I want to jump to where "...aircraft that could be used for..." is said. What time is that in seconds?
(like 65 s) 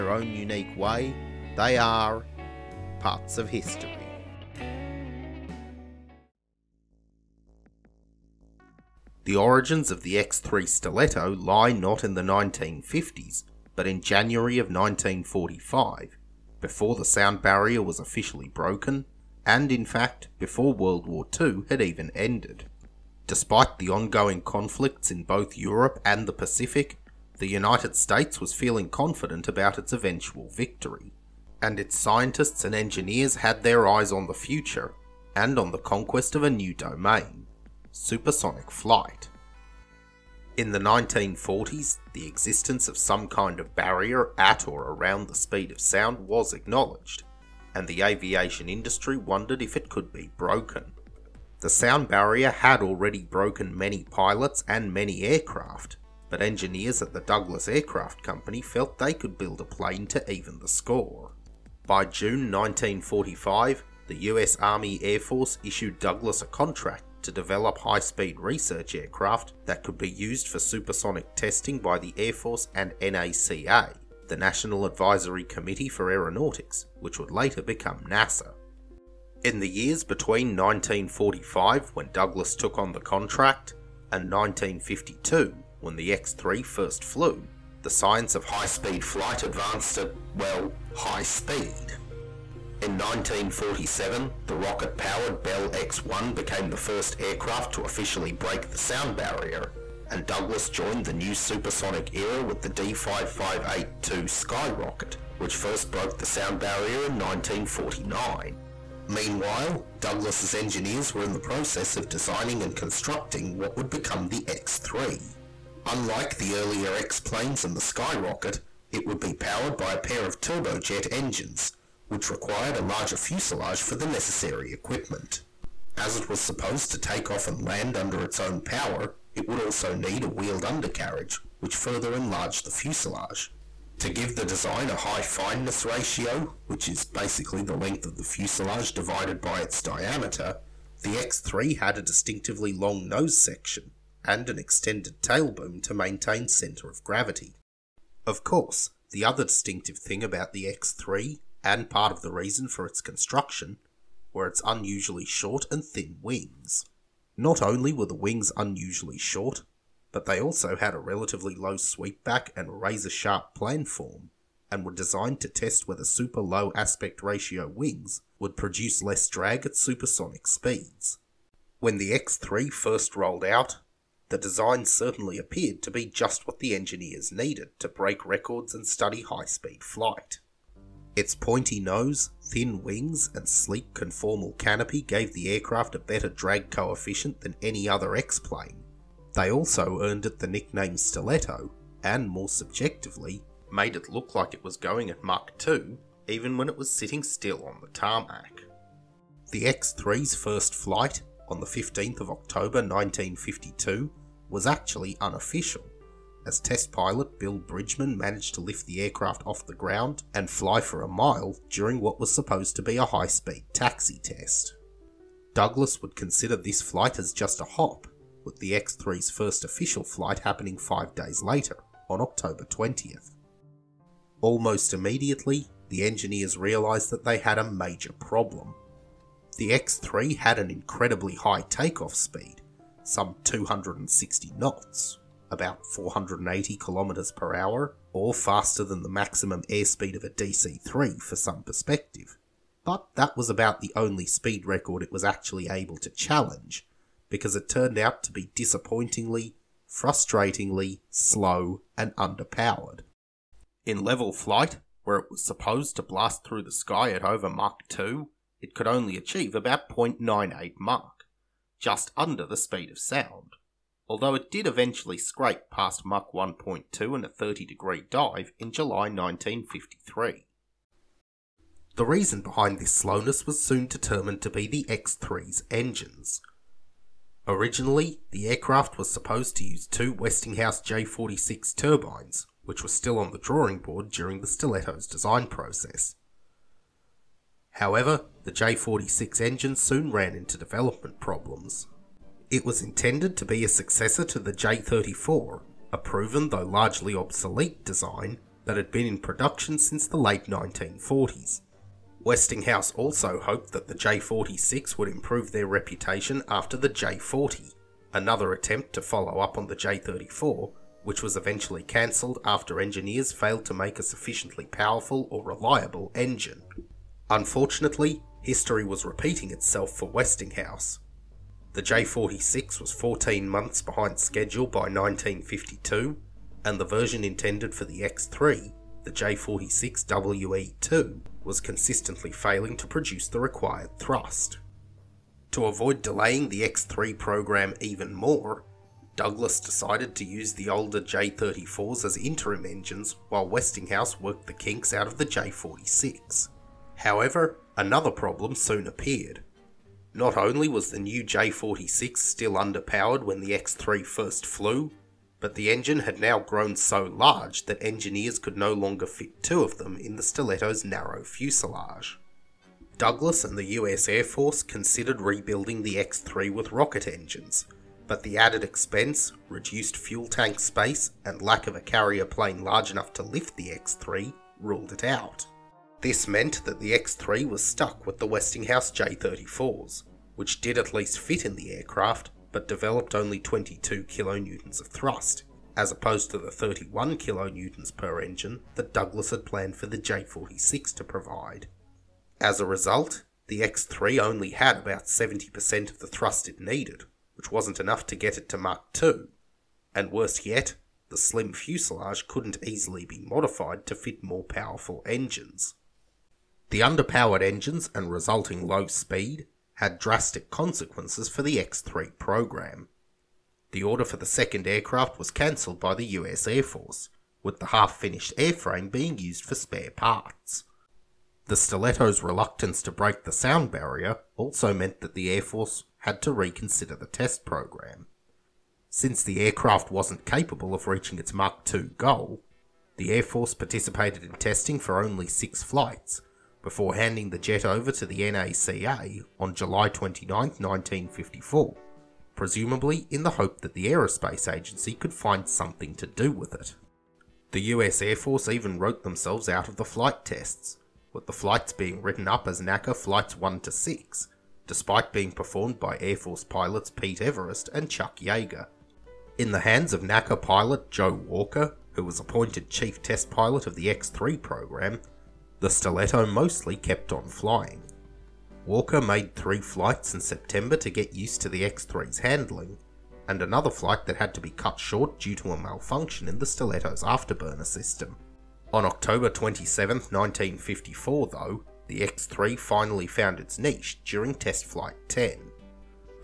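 68 s.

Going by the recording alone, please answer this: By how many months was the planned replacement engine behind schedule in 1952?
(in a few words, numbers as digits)
14 months.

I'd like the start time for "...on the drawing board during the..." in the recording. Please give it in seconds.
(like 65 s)
283 s.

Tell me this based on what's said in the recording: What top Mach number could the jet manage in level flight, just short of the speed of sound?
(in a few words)
0.98.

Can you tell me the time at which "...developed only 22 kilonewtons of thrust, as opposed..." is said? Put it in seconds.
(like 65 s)
382 s.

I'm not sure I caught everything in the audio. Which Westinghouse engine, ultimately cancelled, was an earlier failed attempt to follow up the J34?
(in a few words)
J40.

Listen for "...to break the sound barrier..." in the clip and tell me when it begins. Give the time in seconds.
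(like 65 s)
422 s.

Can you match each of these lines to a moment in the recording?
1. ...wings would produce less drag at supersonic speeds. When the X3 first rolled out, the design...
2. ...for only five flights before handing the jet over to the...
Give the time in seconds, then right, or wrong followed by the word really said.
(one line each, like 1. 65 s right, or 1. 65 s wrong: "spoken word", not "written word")
1. 167 s right
2. 434 s wrong: "six", not "five".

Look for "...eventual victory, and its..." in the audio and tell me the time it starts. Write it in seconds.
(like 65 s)
29 s.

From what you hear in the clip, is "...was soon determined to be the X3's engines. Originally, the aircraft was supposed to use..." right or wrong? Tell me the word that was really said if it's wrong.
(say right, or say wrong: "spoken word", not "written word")
right.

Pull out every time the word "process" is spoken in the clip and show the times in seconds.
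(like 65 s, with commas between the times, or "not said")
111 s, 285 s.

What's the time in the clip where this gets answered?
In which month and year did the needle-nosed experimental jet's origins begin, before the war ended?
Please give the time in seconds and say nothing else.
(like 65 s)
14 s.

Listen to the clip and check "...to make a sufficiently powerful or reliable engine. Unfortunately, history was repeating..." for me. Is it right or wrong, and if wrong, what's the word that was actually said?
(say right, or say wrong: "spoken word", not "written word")
right.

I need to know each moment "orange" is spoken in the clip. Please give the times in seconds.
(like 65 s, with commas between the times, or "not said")
not said.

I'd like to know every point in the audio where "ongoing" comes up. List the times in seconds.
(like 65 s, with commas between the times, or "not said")
23 s.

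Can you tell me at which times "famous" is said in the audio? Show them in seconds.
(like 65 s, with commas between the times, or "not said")
not said.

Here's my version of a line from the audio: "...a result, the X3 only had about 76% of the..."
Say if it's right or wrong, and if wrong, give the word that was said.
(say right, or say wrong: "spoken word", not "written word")
wrong: "70", not "76".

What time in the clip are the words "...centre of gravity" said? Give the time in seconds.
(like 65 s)
146 s.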